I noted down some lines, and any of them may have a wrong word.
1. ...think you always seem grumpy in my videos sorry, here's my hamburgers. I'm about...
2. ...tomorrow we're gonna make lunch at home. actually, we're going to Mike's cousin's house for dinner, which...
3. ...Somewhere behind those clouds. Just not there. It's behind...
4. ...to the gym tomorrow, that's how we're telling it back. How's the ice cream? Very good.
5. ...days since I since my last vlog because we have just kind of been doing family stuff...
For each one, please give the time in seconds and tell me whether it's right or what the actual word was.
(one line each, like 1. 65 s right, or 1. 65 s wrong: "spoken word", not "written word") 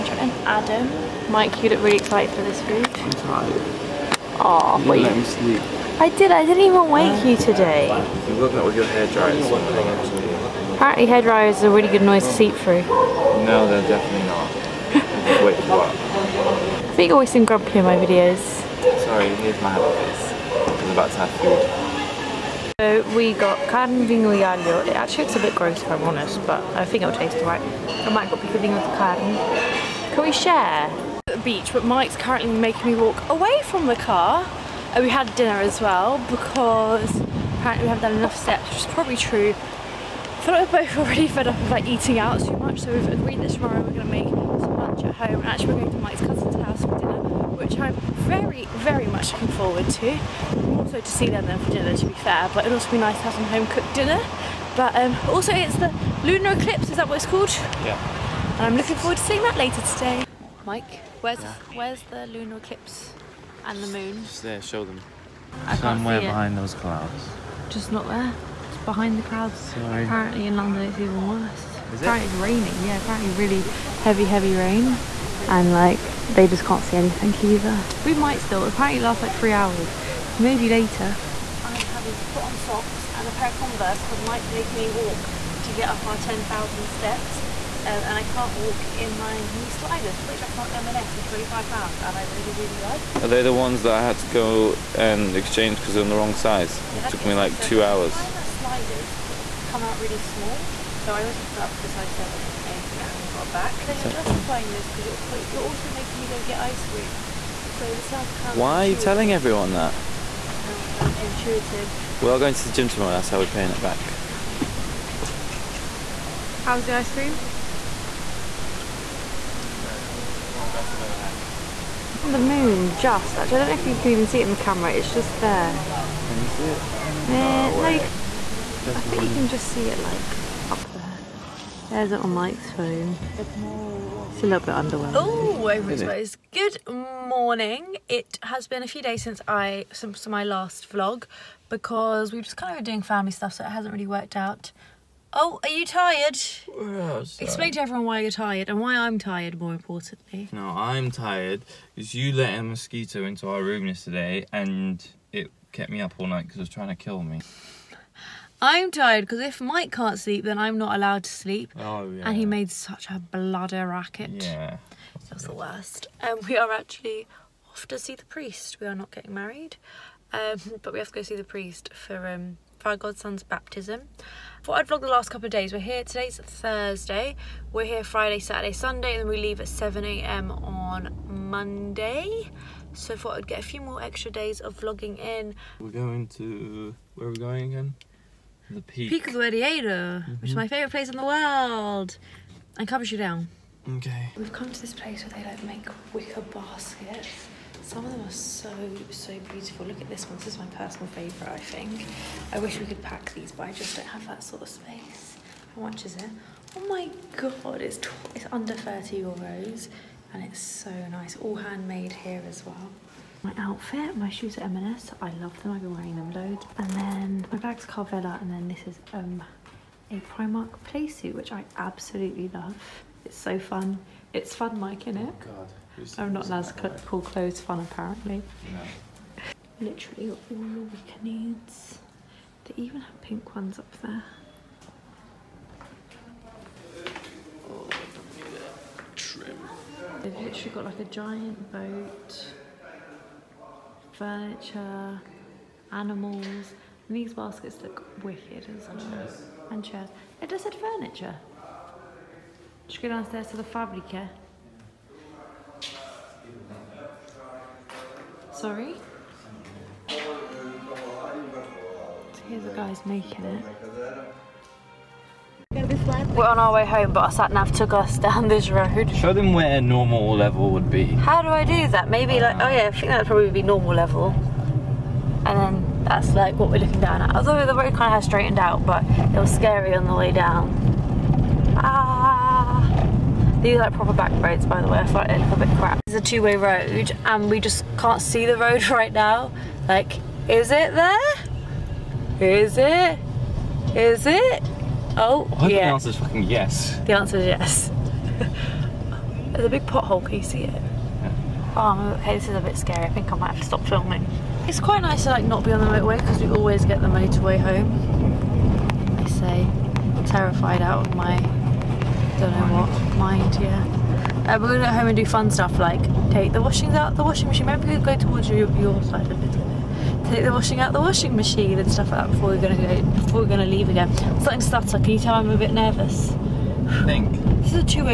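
1. 16 s right
2. 43 s right
3. 65 s right
4. 112 s wrong: "paying", not "telling"
5. 138 s right.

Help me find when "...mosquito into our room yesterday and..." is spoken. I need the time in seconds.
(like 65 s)
152 s.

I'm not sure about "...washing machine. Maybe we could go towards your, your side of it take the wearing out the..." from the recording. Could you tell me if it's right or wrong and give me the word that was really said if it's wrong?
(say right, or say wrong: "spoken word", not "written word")
wrong: "washing", not "wearing".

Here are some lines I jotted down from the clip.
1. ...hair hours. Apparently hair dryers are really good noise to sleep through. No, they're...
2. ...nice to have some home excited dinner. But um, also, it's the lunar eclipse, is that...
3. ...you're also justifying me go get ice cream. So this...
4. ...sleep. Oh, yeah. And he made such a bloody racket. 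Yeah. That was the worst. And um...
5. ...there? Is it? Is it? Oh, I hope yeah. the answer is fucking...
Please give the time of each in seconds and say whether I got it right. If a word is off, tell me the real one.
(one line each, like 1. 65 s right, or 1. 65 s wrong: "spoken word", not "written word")
1. 8 s wrong: "dryers", not "hours"
2. 52 s wrong: "cooked", not "excited"
3. 105 s wrong: "making", not "justifying"
4. 161 s right
5. 290 s right.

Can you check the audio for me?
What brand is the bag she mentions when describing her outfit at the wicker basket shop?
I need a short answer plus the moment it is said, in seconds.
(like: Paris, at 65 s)
Carvela, at 217 s.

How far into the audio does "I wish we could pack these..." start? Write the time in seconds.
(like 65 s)
202 s.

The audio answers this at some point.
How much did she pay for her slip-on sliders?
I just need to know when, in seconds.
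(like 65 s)
91 s.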